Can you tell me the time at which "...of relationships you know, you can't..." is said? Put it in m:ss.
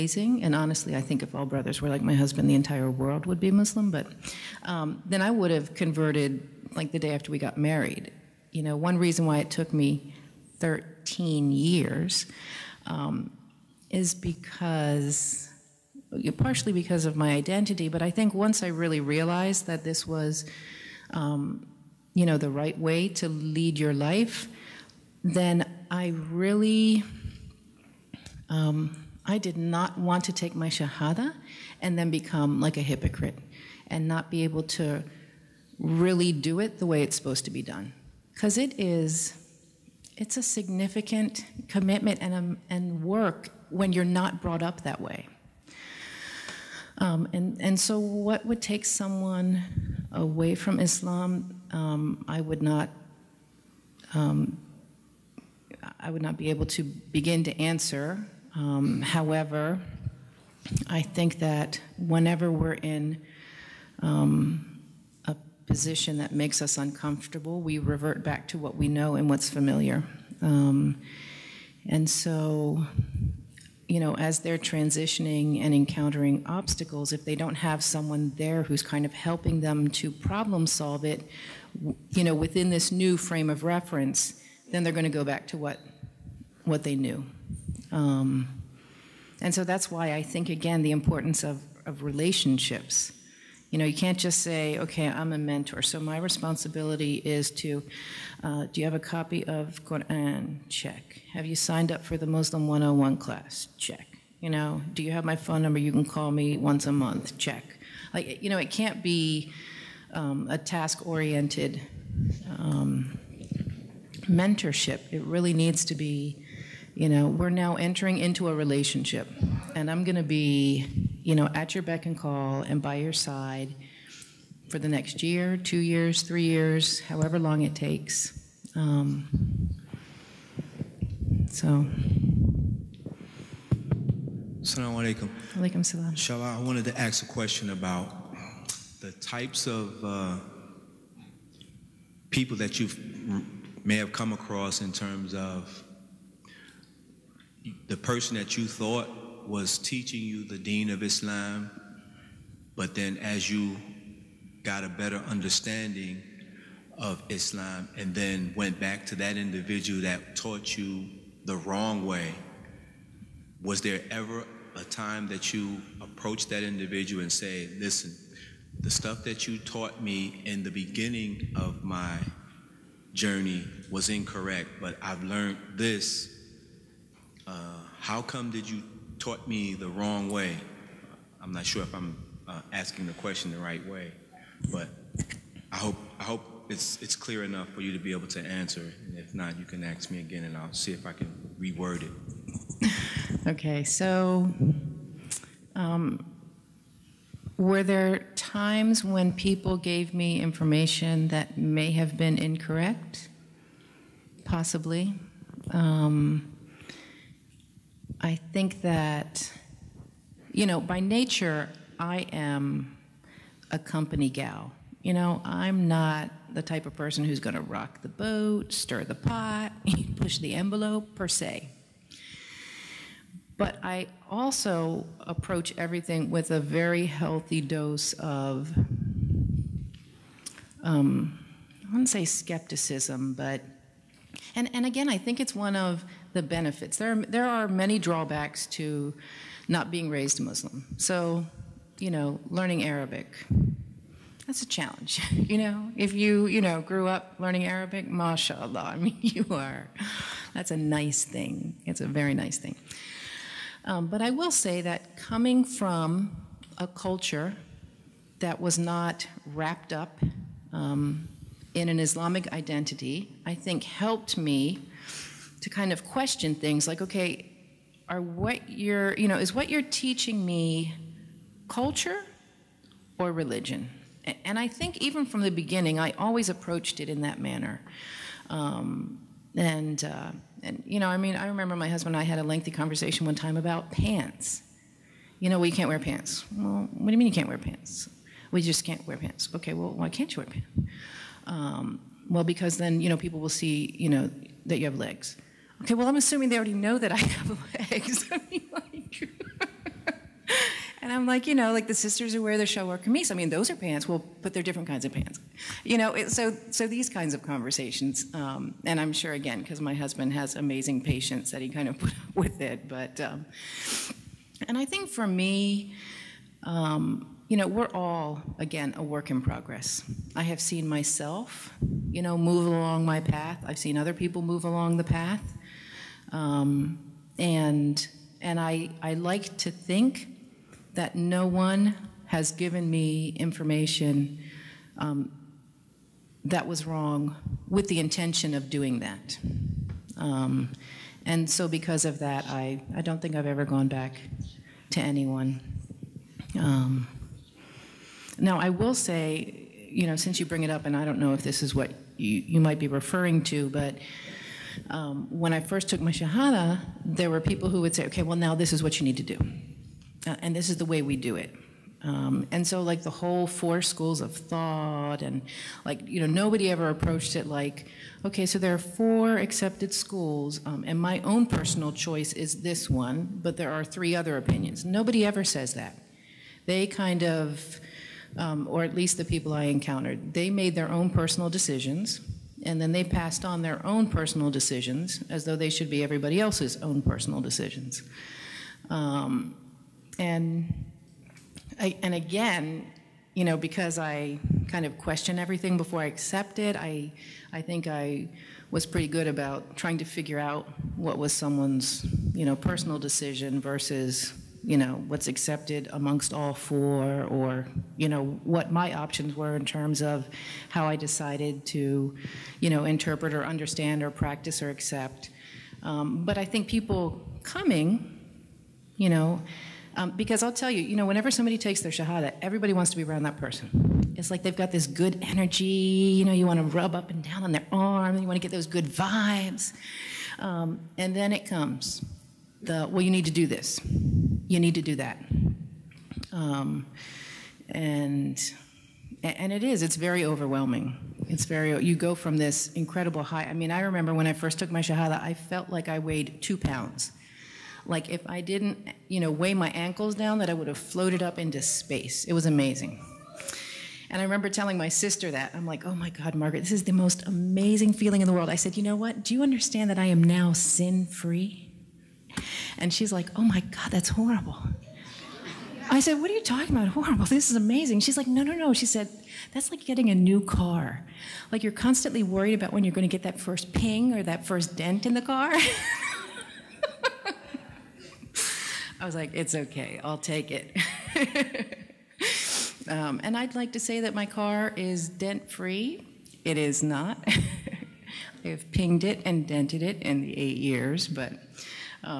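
1:31.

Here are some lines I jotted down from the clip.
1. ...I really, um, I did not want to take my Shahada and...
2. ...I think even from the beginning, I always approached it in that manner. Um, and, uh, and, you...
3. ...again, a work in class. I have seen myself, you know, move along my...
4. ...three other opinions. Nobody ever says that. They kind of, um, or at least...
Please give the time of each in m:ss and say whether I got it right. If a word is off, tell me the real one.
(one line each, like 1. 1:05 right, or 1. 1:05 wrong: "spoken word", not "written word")
1. 0:25 right
2. 4:34 right
3. 5:18 wrong: "progress", not "class"
4. 6:13 right.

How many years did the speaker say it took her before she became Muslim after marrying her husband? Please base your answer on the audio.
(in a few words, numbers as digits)
13.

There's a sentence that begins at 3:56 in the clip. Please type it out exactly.
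There are, there are many drawbacks to not being raised Muslim.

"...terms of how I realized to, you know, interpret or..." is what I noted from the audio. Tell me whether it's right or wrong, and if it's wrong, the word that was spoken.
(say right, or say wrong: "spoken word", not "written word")
wrong: "decided", not "realized".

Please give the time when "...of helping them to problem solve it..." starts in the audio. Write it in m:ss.
1:19.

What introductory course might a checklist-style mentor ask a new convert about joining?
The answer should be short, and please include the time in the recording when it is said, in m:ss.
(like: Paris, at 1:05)
Muslim 101, at 1:42.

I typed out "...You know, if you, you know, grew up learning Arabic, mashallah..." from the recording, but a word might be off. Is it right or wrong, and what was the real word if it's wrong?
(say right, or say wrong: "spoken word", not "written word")
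right.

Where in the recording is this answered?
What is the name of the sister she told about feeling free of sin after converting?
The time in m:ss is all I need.
7:36.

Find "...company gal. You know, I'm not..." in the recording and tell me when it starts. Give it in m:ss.
3:33.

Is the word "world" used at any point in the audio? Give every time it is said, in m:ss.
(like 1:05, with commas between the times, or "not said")
0:02, 7:38.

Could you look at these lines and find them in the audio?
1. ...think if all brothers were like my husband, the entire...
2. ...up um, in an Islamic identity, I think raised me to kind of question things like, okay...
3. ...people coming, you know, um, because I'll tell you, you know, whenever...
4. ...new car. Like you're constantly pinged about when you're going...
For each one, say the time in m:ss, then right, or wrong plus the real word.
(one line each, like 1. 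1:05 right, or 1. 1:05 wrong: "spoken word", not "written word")
1. 0:01 right
2. 4:19 wrong: "helped", not "raised"
3. 6:56 right
4. 7:50 wrong: "worried", not "pinged".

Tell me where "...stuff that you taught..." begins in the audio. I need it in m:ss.
2:48.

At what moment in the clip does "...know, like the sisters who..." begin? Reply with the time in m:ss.
5:01.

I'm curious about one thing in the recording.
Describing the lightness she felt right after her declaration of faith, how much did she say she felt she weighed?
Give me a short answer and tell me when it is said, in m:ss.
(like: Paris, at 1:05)
2 pounds, at 7:26.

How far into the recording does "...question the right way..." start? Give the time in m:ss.
3:03.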